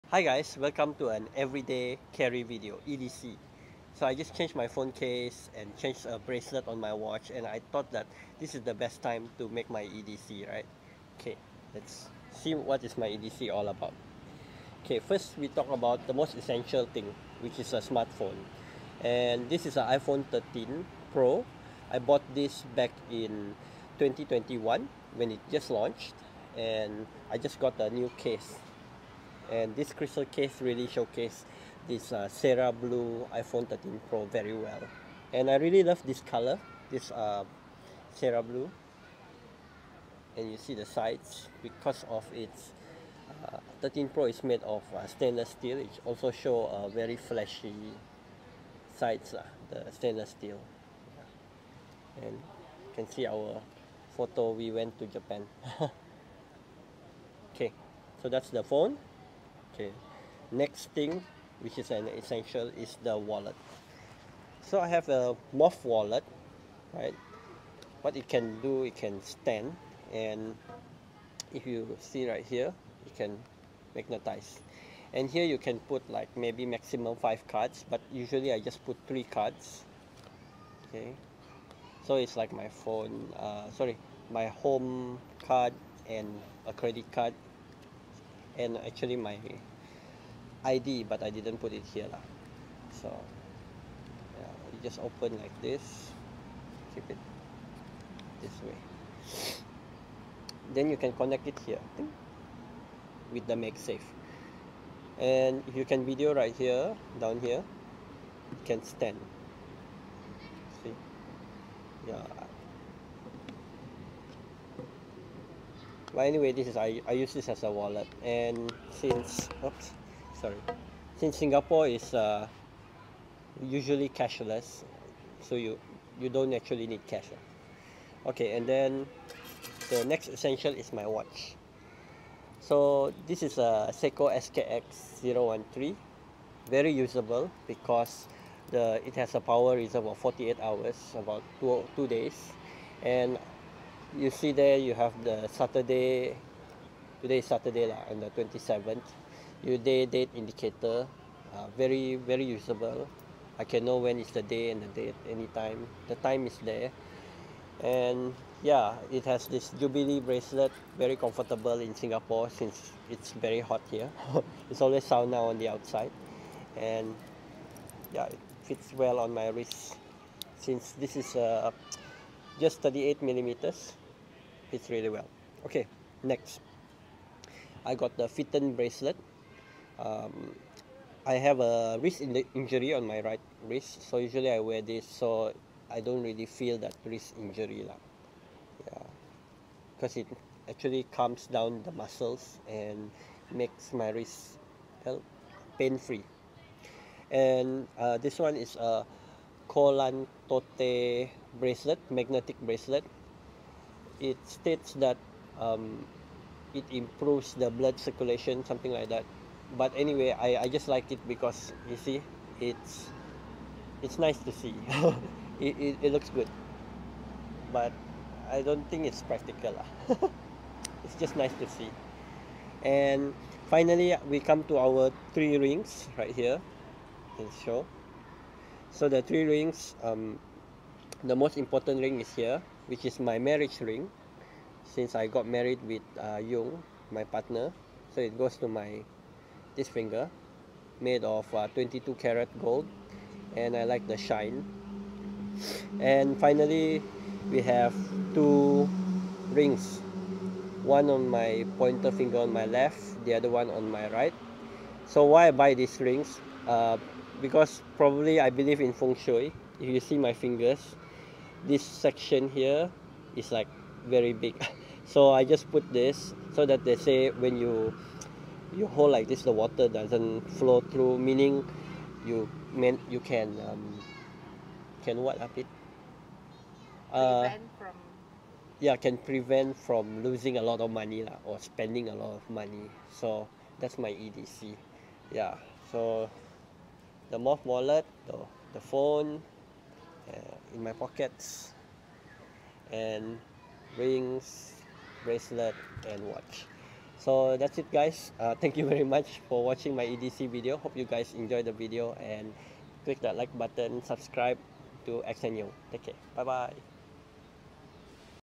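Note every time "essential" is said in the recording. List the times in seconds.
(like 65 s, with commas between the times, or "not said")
16 s, 62 s, 130 s.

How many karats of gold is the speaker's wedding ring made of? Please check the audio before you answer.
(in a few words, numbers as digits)
22.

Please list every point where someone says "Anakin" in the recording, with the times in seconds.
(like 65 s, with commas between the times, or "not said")
not said.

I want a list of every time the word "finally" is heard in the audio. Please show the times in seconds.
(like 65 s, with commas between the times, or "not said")
223 s, 246 s.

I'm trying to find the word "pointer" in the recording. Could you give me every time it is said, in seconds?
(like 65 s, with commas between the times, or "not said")
251 s.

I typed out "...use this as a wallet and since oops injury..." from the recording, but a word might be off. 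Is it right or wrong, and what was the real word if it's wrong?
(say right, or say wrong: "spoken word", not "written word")
wrong: "sorry", not "injury".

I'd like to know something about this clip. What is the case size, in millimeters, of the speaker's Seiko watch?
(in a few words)
38.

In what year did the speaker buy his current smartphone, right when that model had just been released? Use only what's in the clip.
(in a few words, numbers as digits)
2021.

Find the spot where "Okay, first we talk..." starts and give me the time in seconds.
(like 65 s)
14 s.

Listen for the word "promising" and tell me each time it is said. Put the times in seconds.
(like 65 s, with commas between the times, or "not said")
not said.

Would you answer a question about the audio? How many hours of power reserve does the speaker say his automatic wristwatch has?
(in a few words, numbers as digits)
48.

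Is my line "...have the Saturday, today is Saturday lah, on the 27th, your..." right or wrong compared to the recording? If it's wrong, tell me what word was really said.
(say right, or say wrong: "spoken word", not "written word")
right.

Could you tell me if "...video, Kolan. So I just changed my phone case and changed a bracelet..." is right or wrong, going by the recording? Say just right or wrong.
wrong.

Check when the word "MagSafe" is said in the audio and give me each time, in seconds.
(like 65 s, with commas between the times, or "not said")
103 s.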